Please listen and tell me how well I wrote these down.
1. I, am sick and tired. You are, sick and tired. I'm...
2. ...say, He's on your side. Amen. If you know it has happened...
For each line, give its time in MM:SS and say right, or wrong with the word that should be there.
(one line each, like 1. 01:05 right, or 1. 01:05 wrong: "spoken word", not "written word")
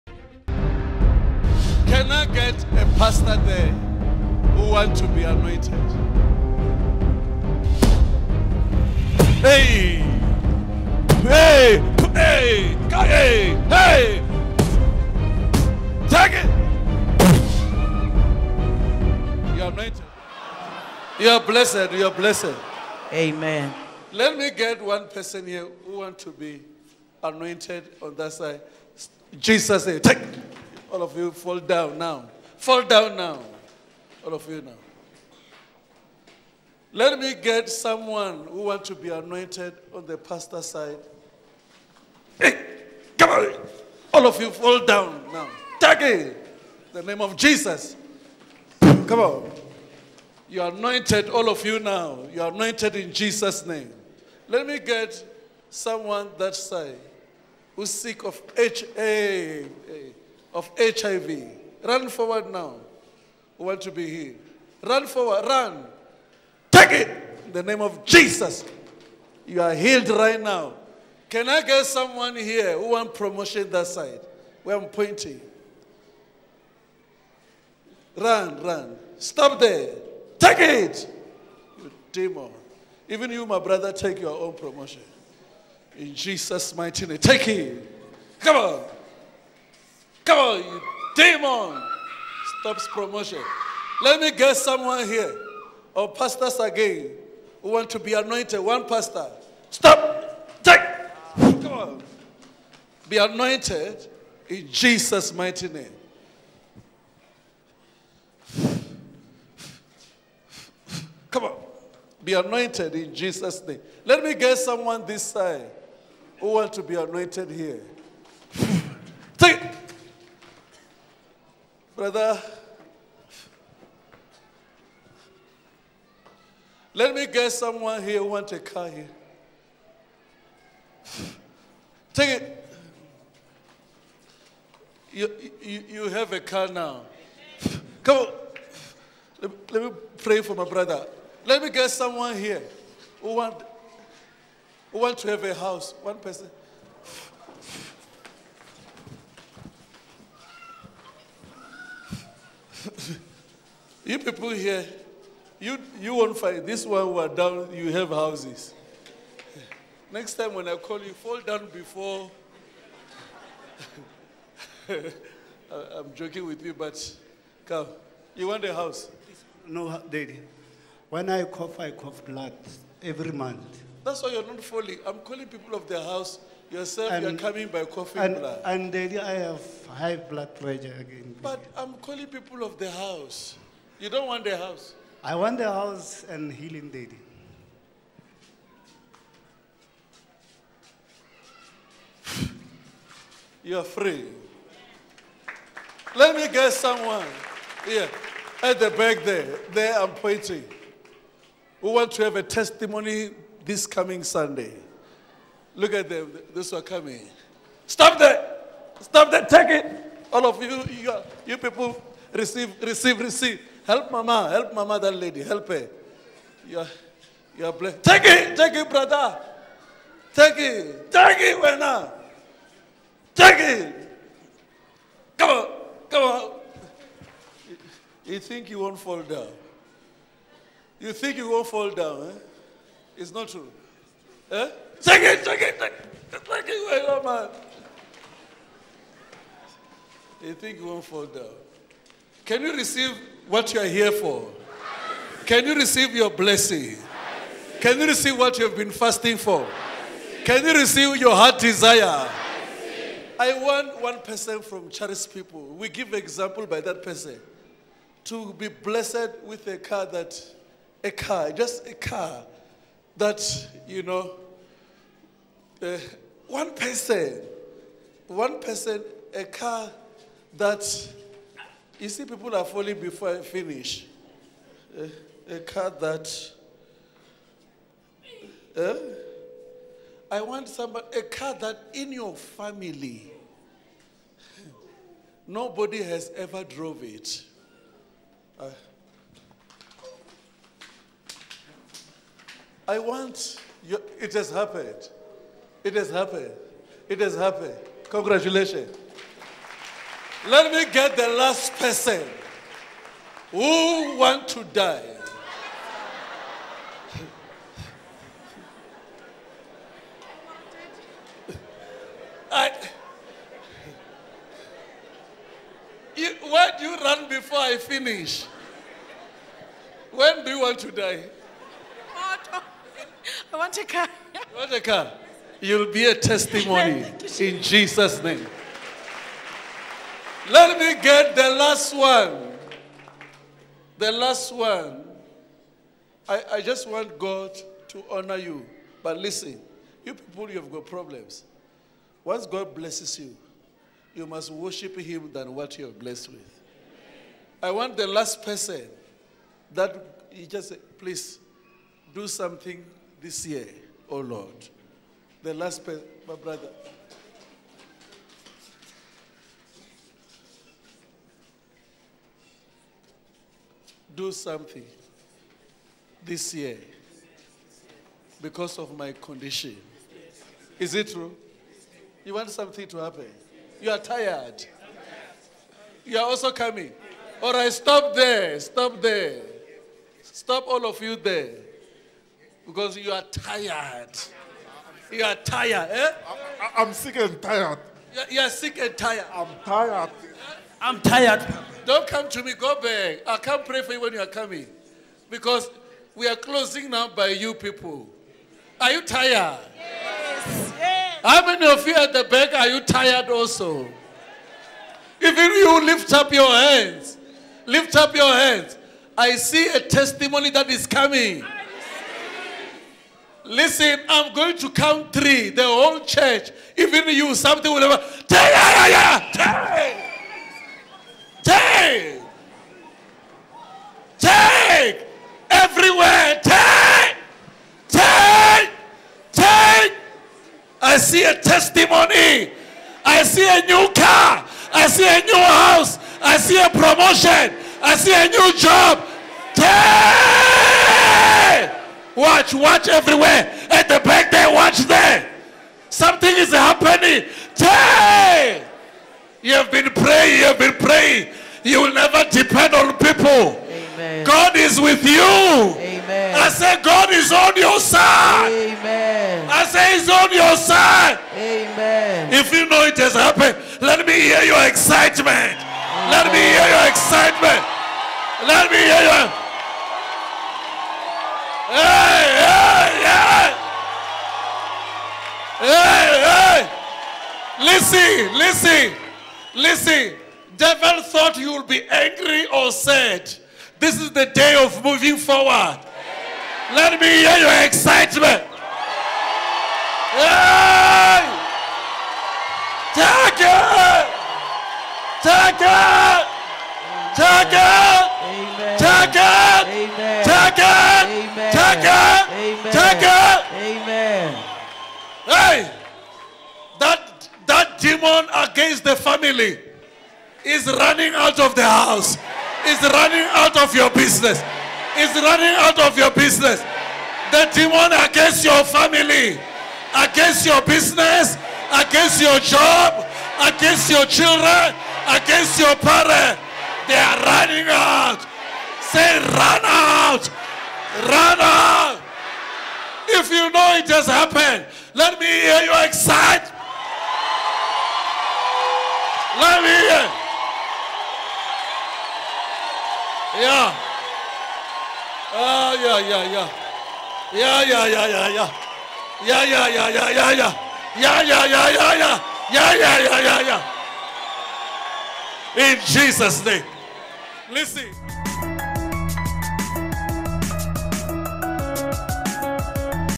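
1. 06:26 right
2. 07:39 right.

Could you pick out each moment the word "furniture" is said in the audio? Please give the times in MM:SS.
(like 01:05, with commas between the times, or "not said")
not said.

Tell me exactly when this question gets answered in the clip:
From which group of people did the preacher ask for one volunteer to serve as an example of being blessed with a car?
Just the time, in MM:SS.
04:14.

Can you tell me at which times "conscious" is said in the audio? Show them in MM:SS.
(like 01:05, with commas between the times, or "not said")
not said.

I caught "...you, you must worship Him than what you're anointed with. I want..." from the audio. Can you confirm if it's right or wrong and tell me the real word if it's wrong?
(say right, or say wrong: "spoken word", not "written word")
wrong: "blessed", not "anointed".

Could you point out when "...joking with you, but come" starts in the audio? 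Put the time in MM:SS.
02:46.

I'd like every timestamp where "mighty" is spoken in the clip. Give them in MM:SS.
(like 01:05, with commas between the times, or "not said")
01:26, 01:45.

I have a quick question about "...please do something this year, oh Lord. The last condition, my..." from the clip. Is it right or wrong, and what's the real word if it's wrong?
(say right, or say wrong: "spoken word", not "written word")
wrong: "person", not "condition".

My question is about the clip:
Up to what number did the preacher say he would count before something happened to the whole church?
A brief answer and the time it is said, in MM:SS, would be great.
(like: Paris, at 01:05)
3, at 06:55.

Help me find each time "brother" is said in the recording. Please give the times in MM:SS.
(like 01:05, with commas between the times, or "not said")
01:23, 02:02, 02:20, 03:38, 05:56.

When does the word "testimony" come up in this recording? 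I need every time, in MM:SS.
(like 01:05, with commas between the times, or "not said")
03:22, 05:26, 06:49, 07:11.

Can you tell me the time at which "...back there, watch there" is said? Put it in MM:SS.
07:24.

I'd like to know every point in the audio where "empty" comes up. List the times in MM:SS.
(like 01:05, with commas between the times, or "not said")
not said.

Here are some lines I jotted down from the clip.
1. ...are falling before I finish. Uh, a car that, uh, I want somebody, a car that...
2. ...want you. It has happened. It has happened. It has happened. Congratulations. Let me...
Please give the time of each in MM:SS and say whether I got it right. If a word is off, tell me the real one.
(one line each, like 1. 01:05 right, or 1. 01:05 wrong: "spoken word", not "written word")
1. 04:32 right
2. 04:52 right.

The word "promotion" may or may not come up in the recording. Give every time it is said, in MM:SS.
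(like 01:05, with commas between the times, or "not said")
01:13, 01:24, 01:32, 07:16.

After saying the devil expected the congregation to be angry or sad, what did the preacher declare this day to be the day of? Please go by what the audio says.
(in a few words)
moving forward.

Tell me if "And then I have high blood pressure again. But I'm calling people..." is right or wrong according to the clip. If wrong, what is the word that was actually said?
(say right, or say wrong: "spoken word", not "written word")
right.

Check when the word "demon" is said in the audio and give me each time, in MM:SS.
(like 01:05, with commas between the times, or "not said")
01:22, 01:31, 08:28, 08:37.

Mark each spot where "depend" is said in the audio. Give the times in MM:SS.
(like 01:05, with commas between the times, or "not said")
07:32.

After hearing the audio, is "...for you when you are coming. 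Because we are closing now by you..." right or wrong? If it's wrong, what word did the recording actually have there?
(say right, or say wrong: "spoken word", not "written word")
right.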